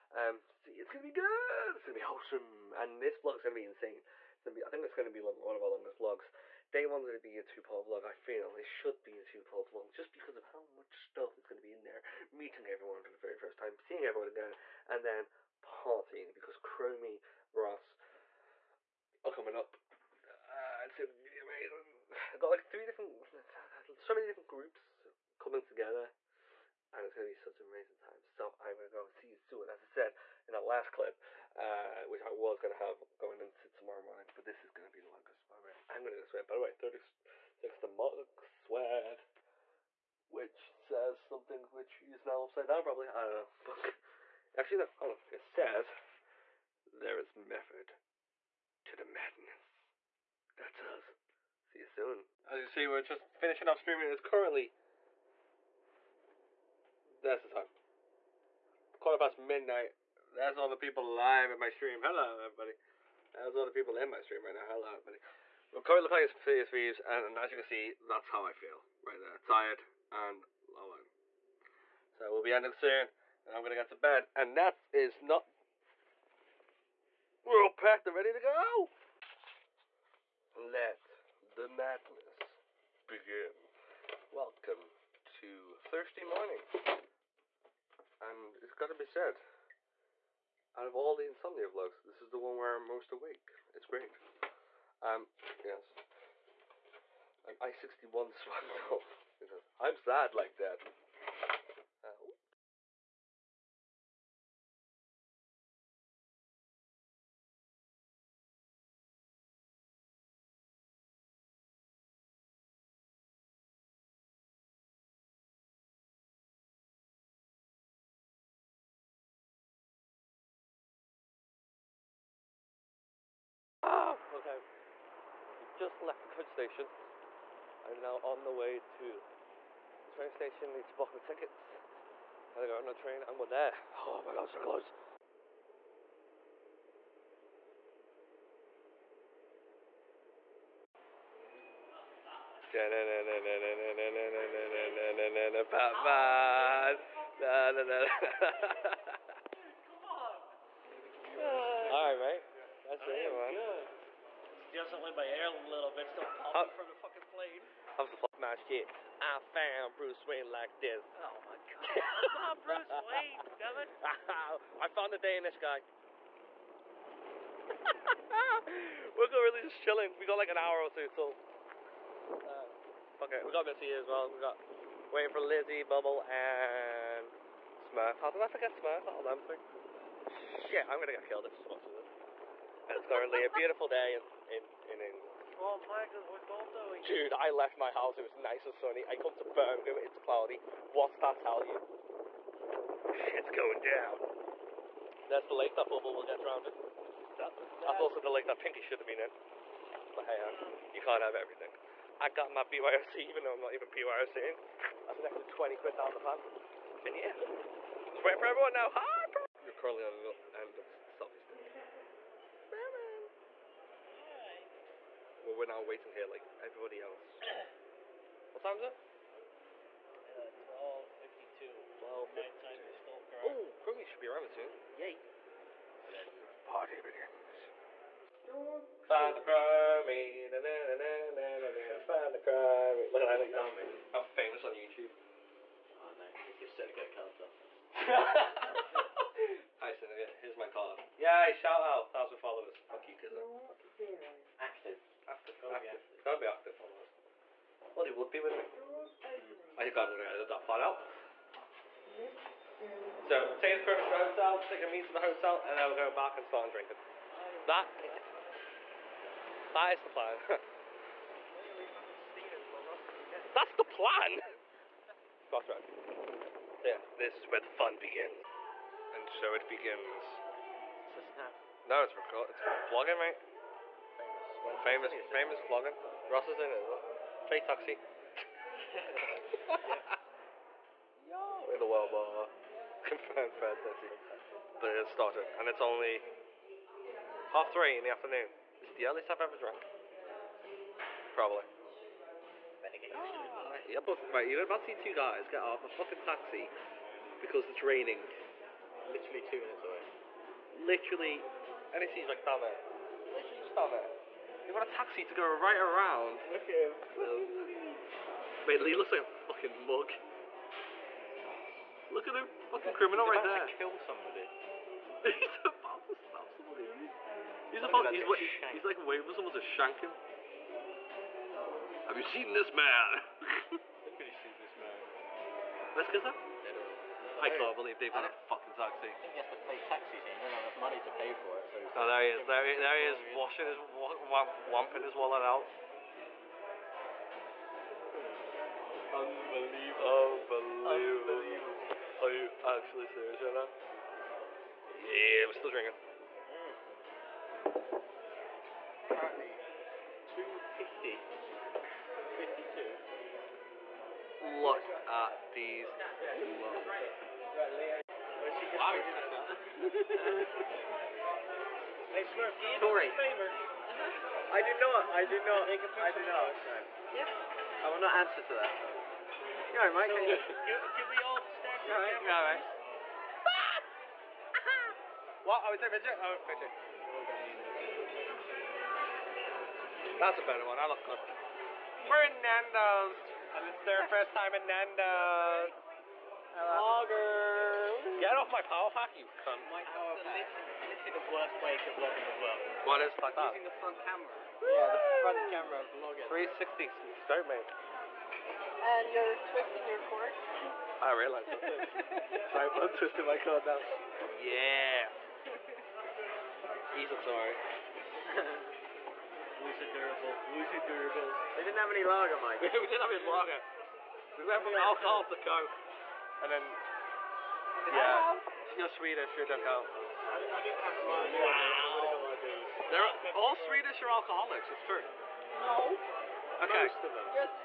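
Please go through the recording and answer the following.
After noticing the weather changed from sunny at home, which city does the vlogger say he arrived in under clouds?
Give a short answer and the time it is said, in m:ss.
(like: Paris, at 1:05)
Birmingham, at 3:09.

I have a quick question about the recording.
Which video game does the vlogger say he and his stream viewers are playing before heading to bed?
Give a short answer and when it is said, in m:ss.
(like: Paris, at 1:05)
Sea of Thieves, at 1:06.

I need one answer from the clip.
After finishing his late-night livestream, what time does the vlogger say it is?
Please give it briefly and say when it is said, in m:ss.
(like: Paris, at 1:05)
Quarter past midnight, at 0:58.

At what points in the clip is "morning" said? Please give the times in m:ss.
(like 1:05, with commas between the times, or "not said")
0:34, 1:26.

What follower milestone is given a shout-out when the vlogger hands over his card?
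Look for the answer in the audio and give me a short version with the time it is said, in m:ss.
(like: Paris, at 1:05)
1000 followers, at 4:02.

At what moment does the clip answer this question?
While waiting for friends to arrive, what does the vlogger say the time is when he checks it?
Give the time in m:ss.
3:40.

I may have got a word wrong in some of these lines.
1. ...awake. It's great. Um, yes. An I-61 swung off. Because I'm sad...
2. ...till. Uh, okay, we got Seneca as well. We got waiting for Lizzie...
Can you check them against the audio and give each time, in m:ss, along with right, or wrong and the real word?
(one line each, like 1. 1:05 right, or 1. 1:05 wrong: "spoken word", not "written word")
1. 1:33 right
2. 2:51 wrong: "Missy", not "Seneca".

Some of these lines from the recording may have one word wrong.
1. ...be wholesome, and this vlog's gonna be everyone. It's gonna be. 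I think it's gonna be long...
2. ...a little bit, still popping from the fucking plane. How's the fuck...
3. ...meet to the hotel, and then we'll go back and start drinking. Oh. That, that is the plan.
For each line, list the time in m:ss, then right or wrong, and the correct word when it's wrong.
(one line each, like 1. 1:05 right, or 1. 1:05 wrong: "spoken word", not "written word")
1. 0:01 wrong: "insane", not "everyone"
2. 2:35 right
3. 4:14 right.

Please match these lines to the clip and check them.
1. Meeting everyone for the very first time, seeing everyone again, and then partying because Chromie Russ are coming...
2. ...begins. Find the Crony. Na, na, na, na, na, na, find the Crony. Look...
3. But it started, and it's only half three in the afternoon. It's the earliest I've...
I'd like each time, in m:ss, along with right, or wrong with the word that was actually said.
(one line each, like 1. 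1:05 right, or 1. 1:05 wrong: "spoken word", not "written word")
1. 0:12 right
2. 3:46 right
3. 4:44 right.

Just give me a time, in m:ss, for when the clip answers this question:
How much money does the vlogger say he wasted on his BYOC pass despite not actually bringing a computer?
3:25.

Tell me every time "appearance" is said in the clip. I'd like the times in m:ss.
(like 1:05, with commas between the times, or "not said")
not said.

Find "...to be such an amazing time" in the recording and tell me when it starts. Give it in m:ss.
0:27.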